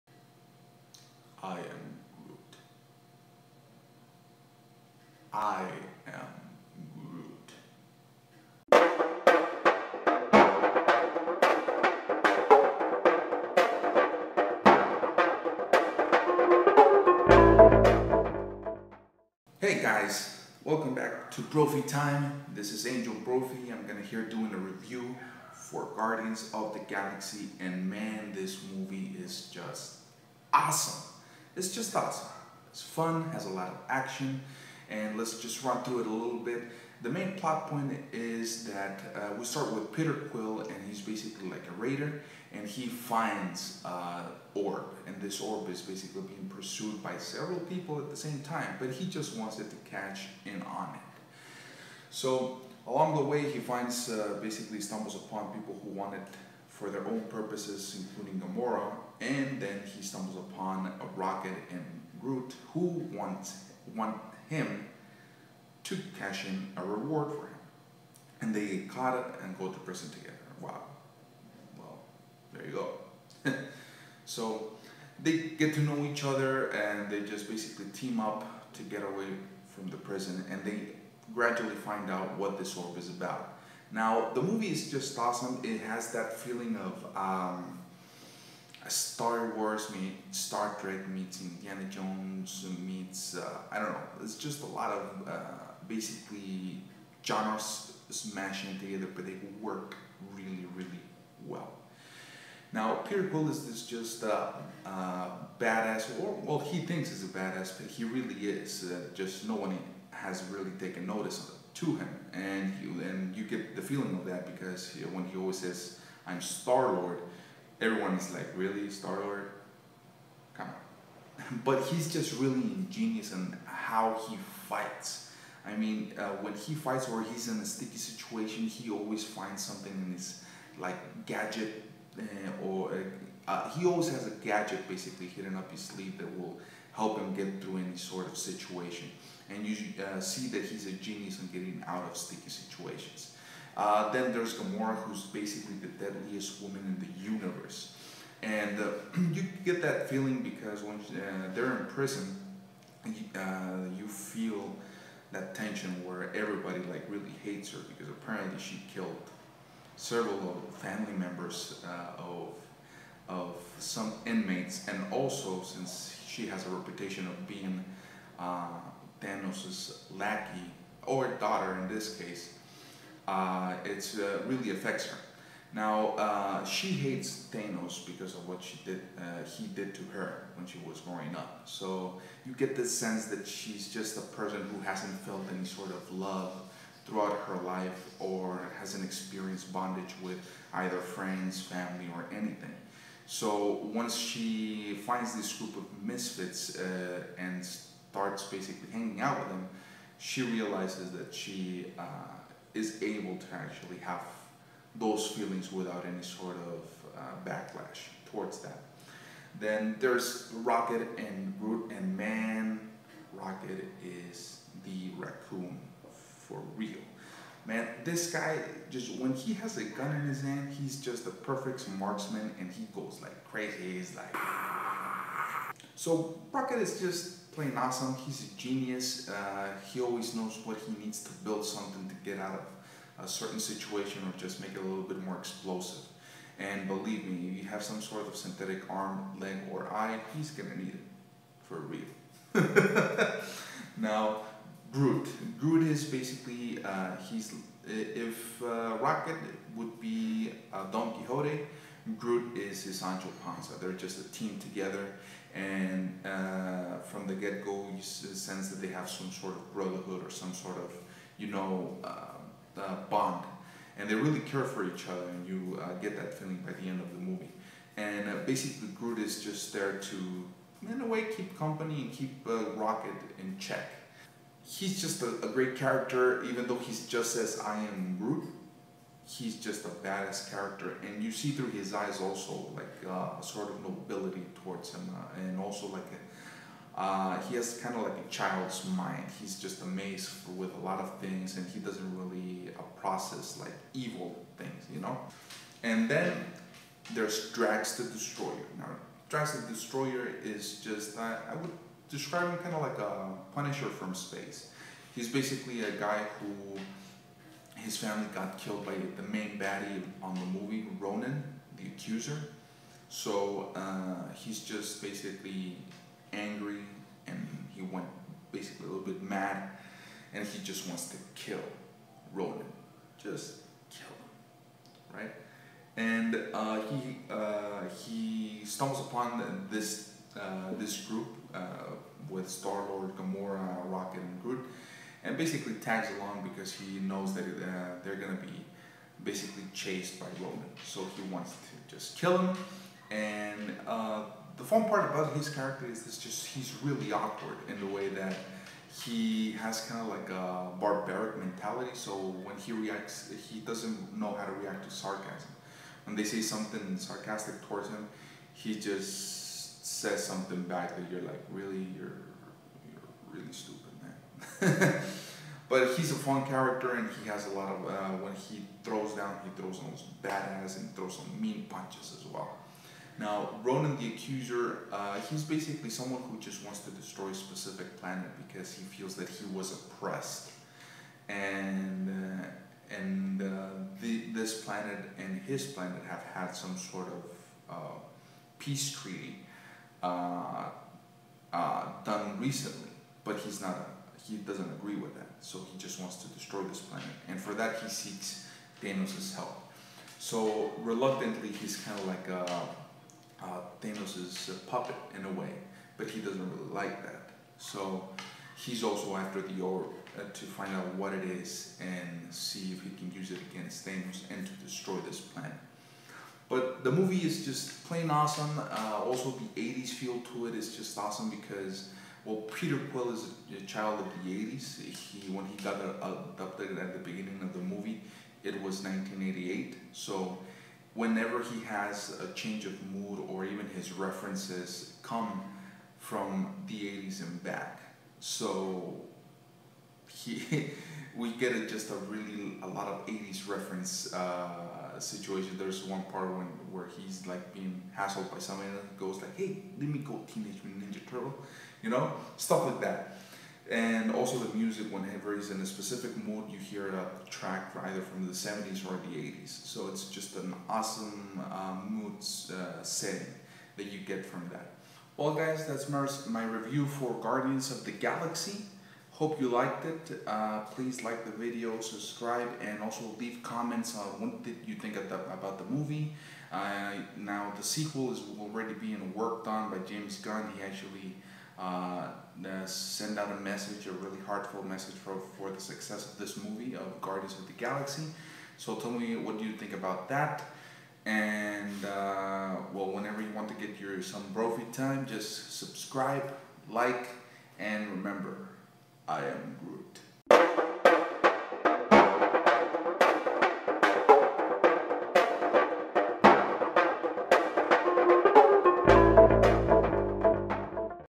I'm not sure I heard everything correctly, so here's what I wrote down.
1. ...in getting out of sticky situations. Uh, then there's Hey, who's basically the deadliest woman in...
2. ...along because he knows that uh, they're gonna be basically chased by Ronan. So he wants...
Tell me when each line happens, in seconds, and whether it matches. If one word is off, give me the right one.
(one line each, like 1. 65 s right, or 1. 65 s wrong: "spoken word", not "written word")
1. 141 s wrong: "Gamora", not "Hey"
2. 336 s right.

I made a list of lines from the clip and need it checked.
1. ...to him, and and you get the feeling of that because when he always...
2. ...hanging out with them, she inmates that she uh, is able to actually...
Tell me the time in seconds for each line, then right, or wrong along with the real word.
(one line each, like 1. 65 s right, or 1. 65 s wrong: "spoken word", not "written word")
1. 111 s right
2. 198 s wrong: "realizes", not "inmates".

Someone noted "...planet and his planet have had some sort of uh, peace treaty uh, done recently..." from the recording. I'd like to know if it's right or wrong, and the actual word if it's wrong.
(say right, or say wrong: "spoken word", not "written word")
right.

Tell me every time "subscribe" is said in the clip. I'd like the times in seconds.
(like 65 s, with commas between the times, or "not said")
471 s, 495 s.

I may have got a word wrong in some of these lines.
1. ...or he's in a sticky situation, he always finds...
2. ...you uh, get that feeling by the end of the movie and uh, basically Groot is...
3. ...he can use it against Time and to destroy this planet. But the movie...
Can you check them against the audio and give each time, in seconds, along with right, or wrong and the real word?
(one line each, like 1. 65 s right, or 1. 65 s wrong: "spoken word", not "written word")
1. 127 s right
2. 265 s right
3. 412 s wrong: "Thanos", not "Time".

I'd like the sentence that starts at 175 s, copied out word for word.
Now, uh, she hates Thanos because of what she did, uh, he did to her when she was growing up.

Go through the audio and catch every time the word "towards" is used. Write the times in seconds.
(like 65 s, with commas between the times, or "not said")
208 s, 284 s, 357 s.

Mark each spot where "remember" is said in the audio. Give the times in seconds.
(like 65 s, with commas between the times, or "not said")
497 s.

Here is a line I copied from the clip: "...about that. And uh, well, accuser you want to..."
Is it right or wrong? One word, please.
wrong.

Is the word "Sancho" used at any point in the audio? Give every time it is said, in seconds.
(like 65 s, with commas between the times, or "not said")
252 s.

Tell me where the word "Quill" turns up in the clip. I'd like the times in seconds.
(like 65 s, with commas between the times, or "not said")
40 s, 103 s, 422 s.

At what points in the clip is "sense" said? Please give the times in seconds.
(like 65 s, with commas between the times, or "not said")
182 s, 258 s.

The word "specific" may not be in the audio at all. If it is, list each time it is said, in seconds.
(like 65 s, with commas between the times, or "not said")
377 s, 455 s.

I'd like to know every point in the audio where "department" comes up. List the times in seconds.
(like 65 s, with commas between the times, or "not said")
not said.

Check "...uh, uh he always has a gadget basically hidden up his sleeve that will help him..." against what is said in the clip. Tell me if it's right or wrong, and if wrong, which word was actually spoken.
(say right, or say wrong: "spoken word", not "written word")
right.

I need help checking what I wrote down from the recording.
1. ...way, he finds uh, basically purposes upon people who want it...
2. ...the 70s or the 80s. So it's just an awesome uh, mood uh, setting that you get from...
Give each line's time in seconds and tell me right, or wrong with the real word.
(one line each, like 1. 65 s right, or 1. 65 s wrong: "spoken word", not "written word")
1. 53 s wrong: "stumbles", not "purposes"
2. 458 s right.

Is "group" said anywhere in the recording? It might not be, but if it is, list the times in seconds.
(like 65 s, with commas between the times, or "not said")
195 s, 331 s.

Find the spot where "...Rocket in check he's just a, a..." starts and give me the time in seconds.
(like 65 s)
272 s.